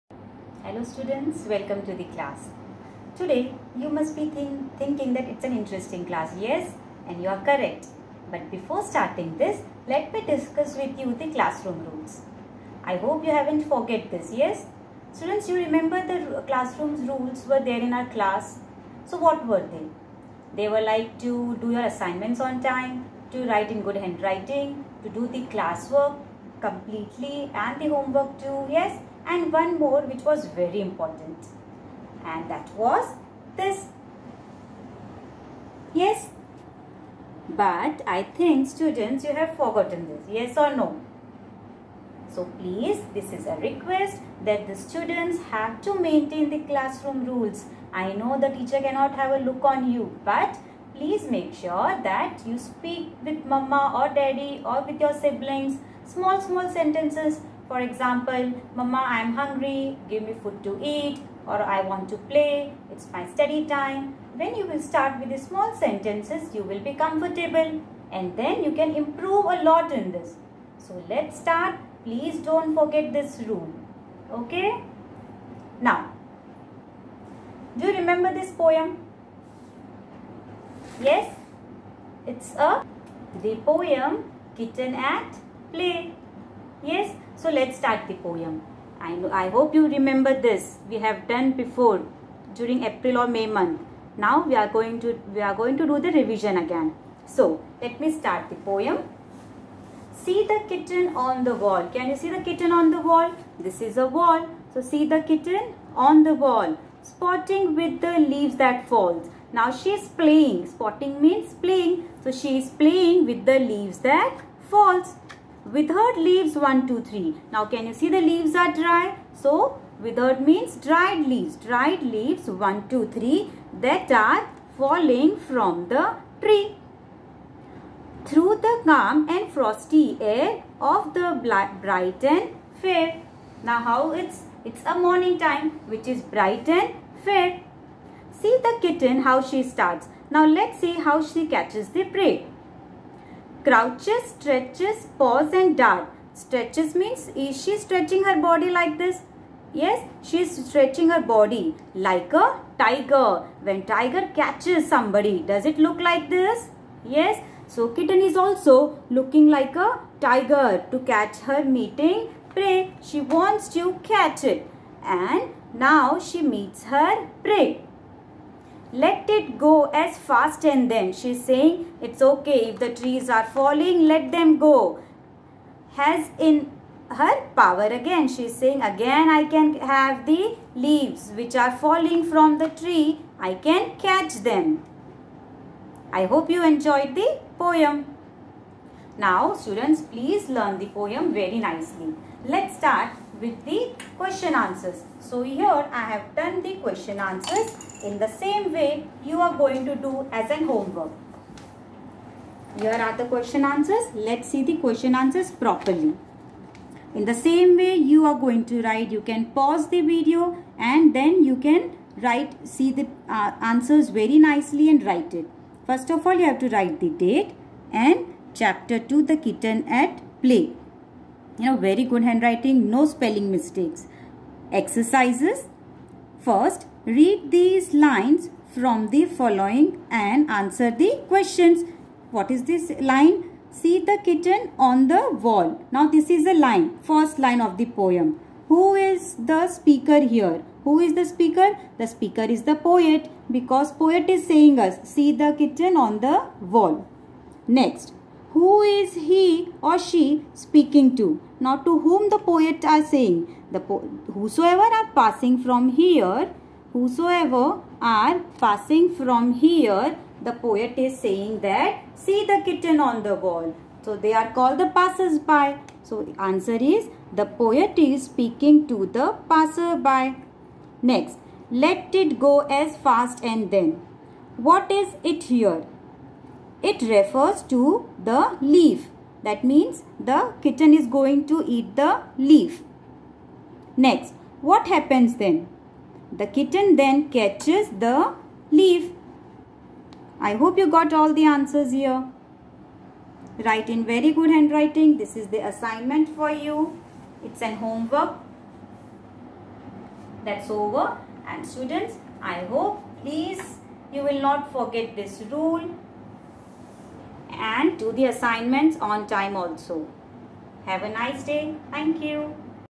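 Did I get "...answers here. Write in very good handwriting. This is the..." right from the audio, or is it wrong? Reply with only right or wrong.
right.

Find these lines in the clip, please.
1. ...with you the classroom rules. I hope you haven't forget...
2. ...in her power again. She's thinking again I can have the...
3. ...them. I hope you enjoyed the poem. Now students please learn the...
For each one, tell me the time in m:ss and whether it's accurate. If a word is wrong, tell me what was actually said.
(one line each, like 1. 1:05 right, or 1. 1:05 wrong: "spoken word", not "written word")
1. 0:10 right
2. 2:56 wrong: "saying", not "thinking"
3. 3:04 right.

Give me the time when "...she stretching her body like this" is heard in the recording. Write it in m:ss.
2:27.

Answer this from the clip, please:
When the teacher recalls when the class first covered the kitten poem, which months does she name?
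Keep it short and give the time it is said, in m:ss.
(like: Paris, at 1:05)
April or May, at 1:32.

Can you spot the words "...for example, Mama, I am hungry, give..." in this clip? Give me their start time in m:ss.
0:57.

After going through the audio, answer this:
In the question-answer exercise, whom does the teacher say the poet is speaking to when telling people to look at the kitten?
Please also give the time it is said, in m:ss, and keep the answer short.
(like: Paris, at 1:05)
The passers-by, at 4:29.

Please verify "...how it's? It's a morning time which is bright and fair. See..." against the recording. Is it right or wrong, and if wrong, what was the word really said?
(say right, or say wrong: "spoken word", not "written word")
right.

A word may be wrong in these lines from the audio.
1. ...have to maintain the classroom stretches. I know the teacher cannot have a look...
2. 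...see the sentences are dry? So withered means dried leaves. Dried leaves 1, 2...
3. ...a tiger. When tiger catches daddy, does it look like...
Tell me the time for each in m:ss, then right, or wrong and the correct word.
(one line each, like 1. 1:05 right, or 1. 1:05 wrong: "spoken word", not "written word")
1. 0:45 wrong: "rules", not "stretches"
2. 1:57 wrong: "leaves", not "sentences"
3. 2:32 wrong: "somebody", not "daddy".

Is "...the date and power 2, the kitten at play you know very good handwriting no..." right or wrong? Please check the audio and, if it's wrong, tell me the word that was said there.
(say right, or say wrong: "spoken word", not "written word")
wrong: "chapter", not "power".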